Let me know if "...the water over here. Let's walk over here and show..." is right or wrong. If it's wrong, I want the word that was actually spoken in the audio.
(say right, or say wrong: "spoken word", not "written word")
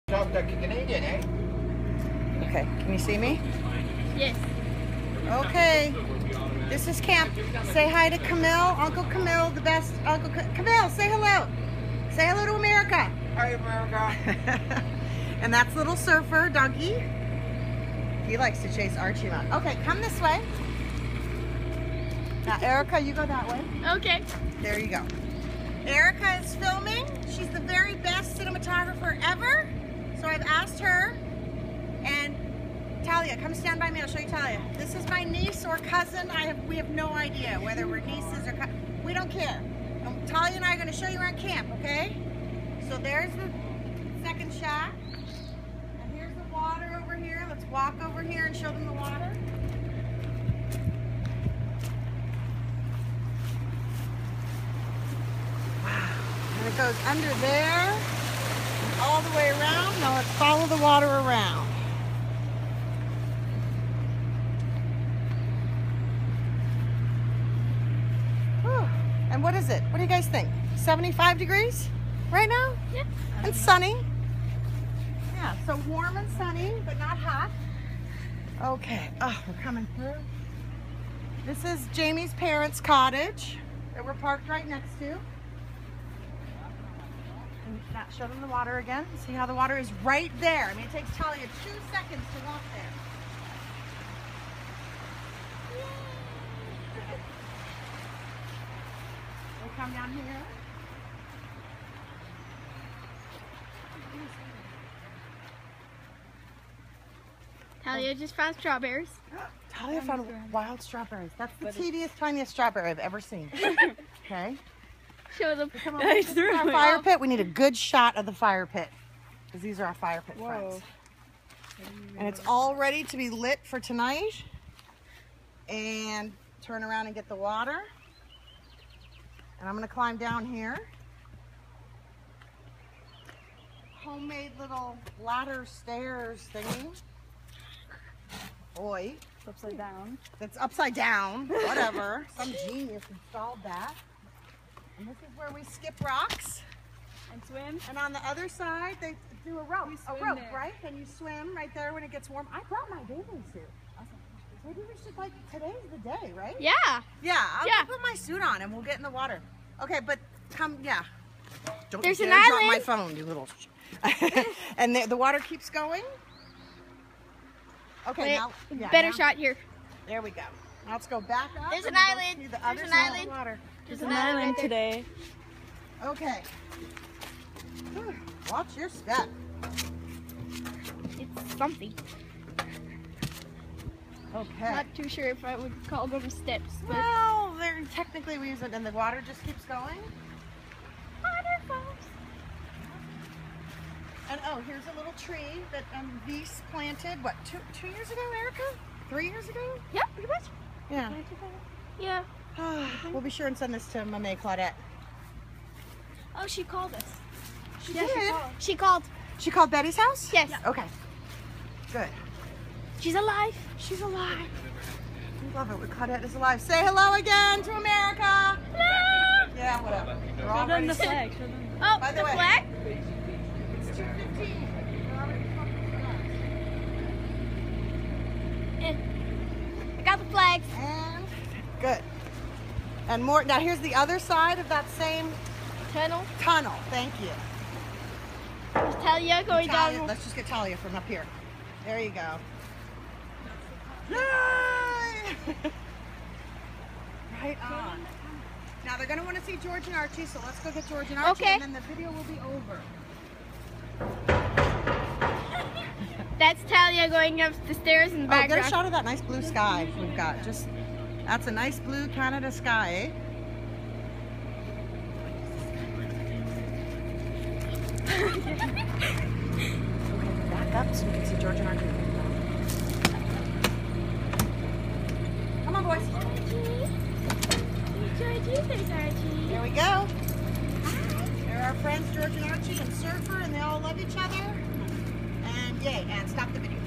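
right.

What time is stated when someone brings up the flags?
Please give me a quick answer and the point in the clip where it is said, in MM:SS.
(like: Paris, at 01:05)
2:15, at 03:43.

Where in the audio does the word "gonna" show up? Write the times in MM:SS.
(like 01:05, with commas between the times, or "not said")
02:09, 04:09.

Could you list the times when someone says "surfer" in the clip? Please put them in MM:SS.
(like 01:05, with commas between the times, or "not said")
00:15, 04:42.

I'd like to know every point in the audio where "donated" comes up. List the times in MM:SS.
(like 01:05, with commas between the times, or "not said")
not said.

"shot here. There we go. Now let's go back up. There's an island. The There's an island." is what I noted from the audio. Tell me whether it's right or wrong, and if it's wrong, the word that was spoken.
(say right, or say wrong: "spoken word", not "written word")
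right.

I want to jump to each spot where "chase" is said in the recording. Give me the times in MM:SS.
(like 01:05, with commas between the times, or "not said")
00:18.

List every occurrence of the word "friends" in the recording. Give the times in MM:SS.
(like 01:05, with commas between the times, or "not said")
02:00, 04:41.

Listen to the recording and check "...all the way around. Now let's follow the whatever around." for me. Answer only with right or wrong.
wrong.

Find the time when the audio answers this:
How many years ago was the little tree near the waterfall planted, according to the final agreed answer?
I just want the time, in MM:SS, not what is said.
03:19.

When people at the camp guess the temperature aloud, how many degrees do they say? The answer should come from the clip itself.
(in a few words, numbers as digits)
75.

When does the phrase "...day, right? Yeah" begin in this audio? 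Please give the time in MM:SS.
02:35.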